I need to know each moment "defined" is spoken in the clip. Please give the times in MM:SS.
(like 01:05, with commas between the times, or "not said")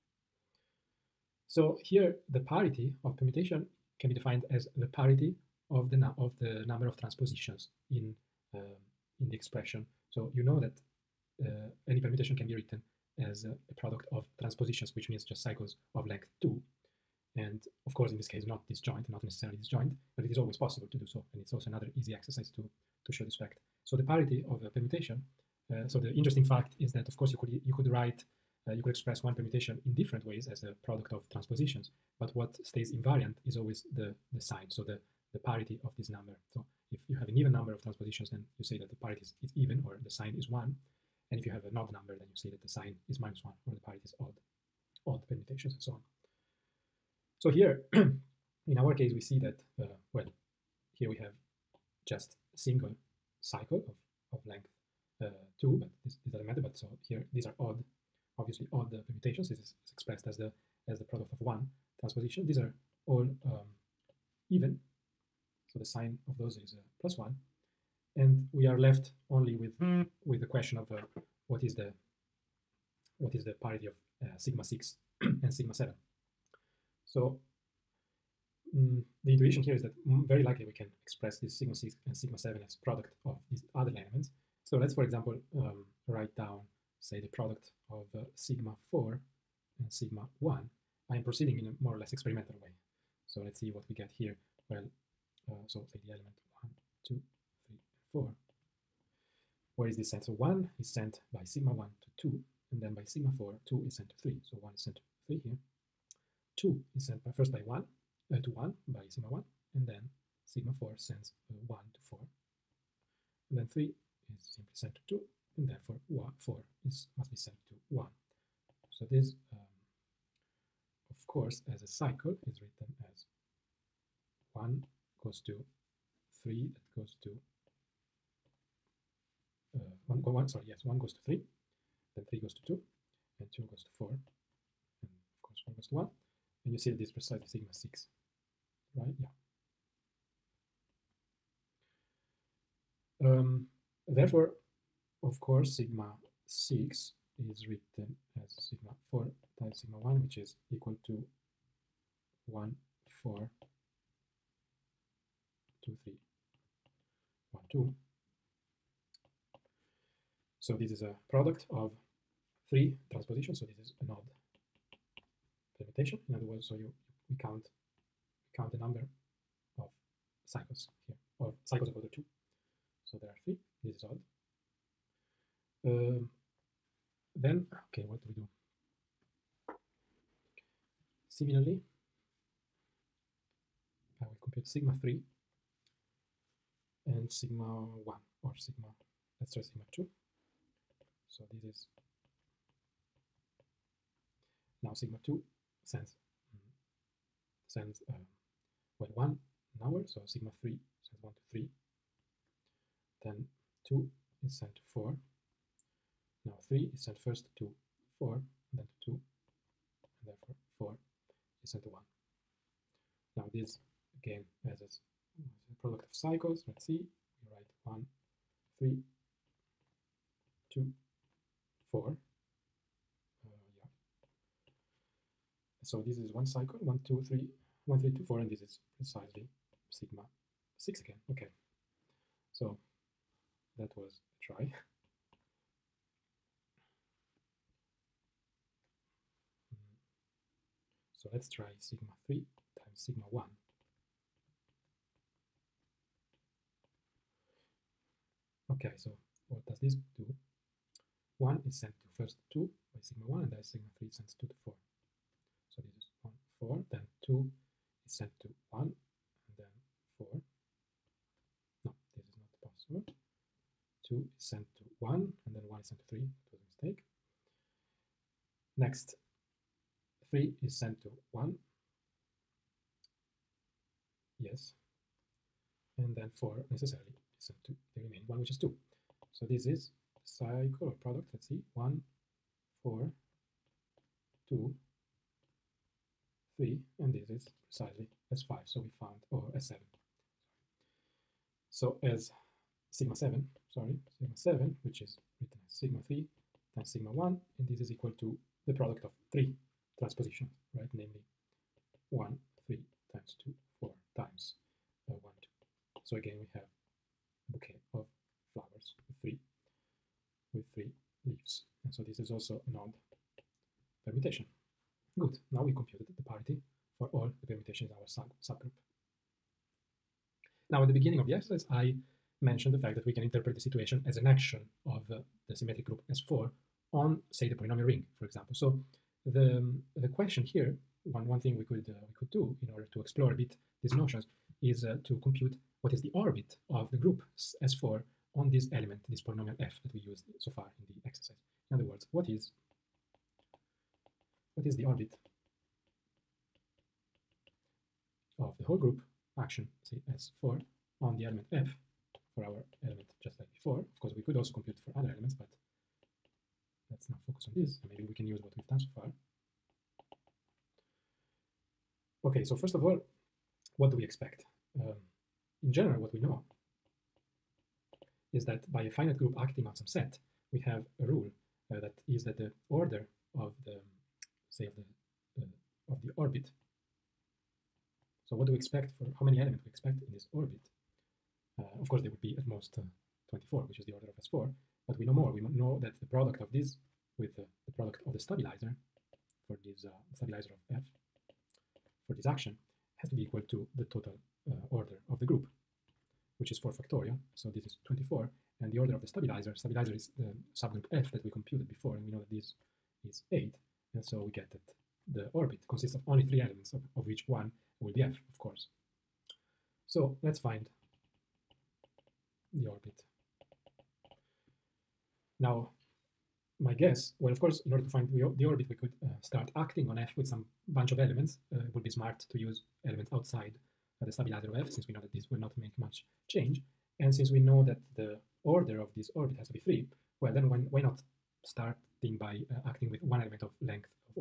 00:04.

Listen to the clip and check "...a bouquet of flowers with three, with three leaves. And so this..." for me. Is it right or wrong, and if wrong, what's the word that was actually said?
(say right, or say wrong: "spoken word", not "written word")
right.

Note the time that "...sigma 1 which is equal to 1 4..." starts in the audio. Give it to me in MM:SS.
02:29.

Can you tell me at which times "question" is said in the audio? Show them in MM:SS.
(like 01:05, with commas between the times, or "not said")
01:10, 05:30.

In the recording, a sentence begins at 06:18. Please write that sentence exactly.
So what do we expect for how many elements we expect in this orbit?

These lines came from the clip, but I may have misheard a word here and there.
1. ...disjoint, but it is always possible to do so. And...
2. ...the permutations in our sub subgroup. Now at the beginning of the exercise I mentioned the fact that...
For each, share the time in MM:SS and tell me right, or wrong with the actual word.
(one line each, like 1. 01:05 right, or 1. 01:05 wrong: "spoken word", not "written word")
1. 00:19 right
2. 05:17 right.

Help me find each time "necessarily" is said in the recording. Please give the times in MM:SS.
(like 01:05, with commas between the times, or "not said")
00:19, 04:36.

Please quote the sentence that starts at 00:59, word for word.
This is is expressed as the as the product of one transposition.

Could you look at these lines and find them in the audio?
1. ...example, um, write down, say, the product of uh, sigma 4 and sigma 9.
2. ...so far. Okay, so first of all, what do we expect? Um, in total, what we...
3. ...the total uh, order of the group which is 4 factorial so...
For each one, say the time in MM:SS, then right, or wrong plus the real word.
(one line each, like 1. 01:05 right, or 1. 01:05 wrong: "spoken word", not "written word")
1. 01:25 wrong: "1", not "9"
2. 05:58 wrong: "general", not "total"
3. 06:33 right.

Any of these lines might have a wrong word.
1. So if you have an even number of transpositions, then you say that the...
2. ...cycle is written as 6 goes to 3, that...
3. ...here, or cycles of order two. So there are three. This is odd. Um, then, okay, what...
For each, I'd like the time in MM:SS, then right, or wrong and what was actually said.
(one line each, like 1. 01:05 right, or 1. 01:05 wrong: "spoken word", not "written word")
1. 00:36 right
2. 02:01 wrong: "1", not "6"
3. 02:51 right.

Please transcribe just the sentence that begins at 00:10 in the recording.
So you know that uh, any permutation can be written as a product of transpositions, which means just cycles of length 2.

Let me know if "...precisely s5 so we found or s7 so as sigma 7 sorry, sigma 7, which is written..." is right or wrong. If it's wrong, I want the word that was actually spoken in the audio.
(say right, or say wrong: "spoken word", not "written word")
right.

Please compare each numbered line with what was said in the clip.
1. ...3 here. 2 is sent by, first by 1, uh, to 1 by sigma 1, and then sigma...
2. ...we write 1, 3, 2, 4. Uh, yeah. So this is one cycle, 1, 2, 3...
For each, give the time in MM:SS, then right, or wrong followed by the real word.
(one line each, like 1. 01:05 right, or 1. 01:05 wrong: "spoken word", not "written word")
1. 01:45 right
2. 03:37 right.